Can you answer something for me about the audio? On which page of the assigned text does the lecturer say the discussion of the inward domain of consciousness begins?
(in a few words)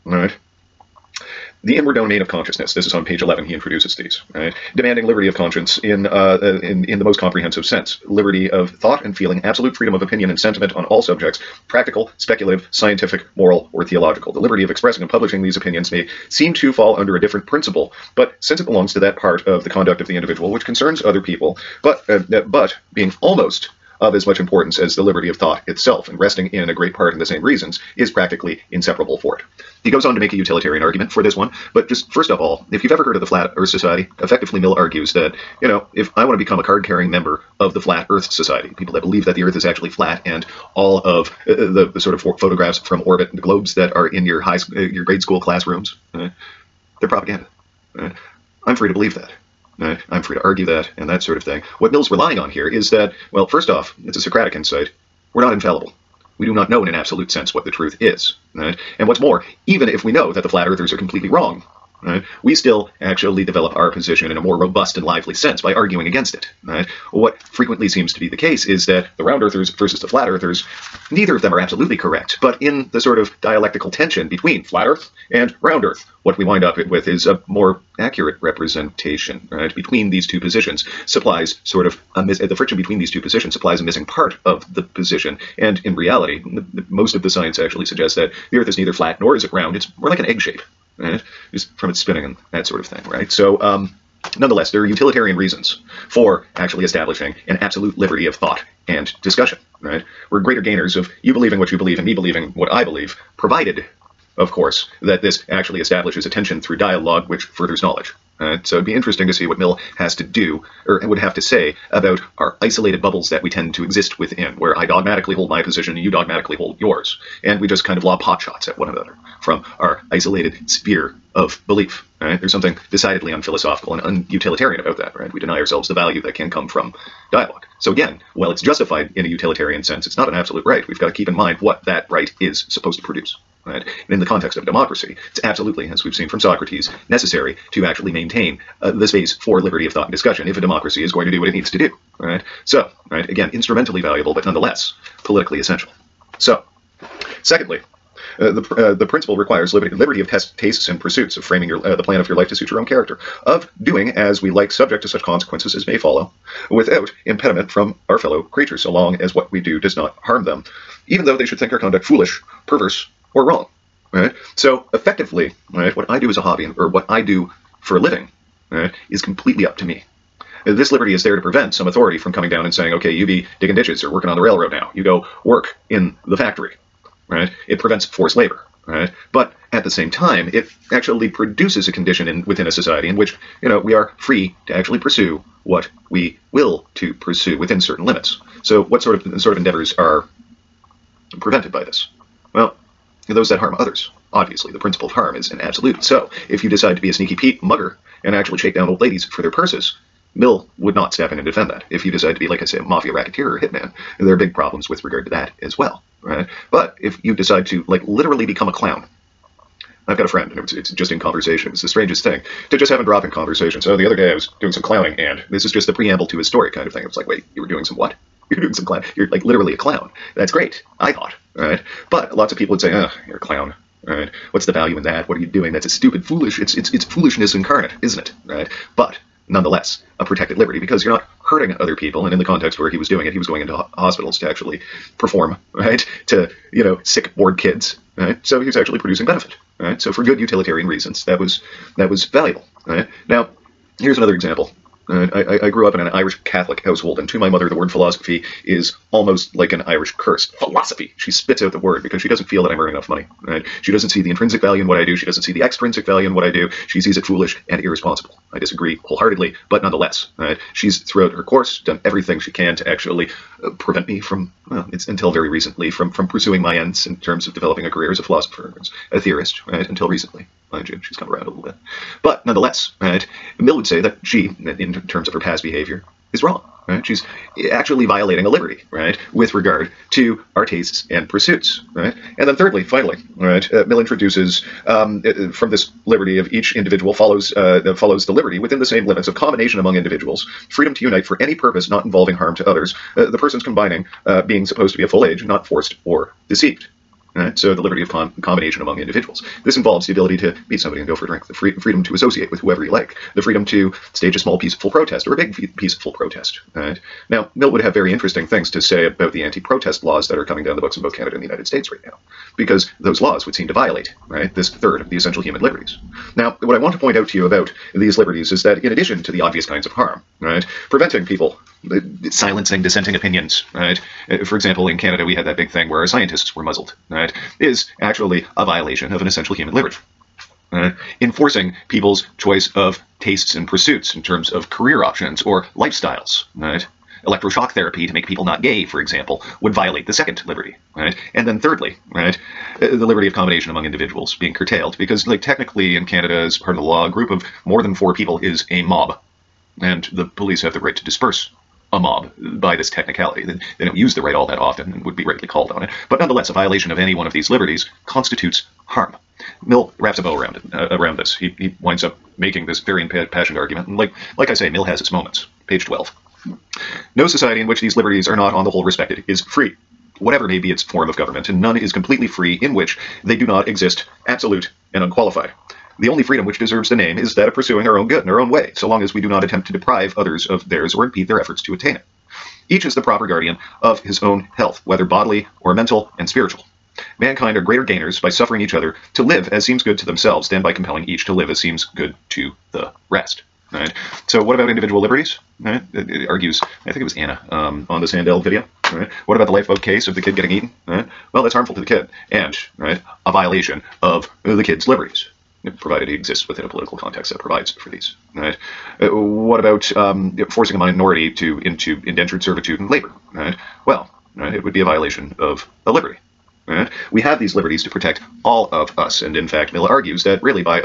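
11.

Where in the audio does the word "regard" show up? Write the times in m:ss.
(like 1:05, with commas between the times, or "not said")
3:25, 4:39.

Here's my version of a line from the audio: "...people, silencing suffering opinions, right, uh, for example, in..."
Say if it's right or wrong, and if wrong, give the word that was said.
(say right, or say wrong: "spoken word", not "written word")
wrong: "dissenting", not "suffering".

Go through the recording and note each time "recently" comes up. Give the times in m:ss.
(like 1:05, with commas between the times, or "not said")
4:25, 4:30.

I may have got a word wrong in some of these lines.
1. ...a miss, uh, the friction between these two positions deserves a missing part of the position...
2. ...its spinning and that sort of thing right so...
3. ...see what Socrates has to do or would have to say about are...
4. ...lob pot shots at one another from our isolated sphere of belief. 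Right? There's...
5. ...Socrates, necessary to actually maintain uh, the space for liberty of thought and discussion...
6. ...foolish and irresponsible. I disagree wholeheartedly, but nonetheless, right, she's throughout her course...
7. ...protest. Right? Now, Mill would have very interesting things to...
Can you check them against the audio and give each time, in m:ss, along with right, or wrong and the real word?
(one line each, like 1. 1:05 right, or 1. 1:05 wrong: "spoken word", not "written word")
1. 1:22 wrong: "supplies", not "deserves"
2. 1:31 right
3. 1:49 wrong: "Mill", not "Socrates"
4. 1:58 right
5. 2:16 right
6. 4:17 right
7. 5:06 right.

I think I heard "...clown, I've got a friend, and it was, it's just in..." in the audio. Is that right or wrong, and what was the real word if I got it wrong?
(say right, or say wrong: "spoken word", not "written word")
right.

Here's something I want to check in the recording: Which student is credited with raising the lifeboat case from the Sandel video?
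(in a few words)
Anna.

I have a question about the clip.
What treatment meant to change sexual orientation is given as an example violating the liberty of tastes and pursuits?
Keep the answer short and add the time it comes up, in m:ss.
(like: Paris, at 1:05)
Electroshock therapy, at 5:37.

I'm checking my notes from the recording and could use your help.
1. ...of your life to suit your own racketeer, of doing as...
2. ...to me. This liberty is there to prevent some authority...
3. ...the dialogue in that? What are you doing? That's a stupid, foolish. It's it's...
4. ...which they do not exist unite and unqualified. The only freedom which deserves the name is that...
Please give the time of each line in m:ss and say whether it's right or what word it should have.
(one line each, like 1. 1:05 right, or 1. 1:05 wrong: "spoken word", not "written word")
1. 2:32 wrong: "character", not "racketeer"
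2. 2:49 right
3. 3:44 wrong: "value", not "dialogue"
4. 6:12 wrong: "absolute", not "unite".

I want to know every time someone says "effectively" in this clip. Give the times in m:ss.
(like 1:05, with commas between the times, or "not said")
0:34, 2:44.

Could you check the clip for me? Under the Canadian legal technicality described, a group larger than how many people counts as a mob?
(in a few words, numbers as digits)
4.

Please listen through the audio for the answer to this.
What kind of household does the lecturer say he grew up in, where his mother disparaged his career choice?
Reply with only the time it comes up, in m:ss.
4:06.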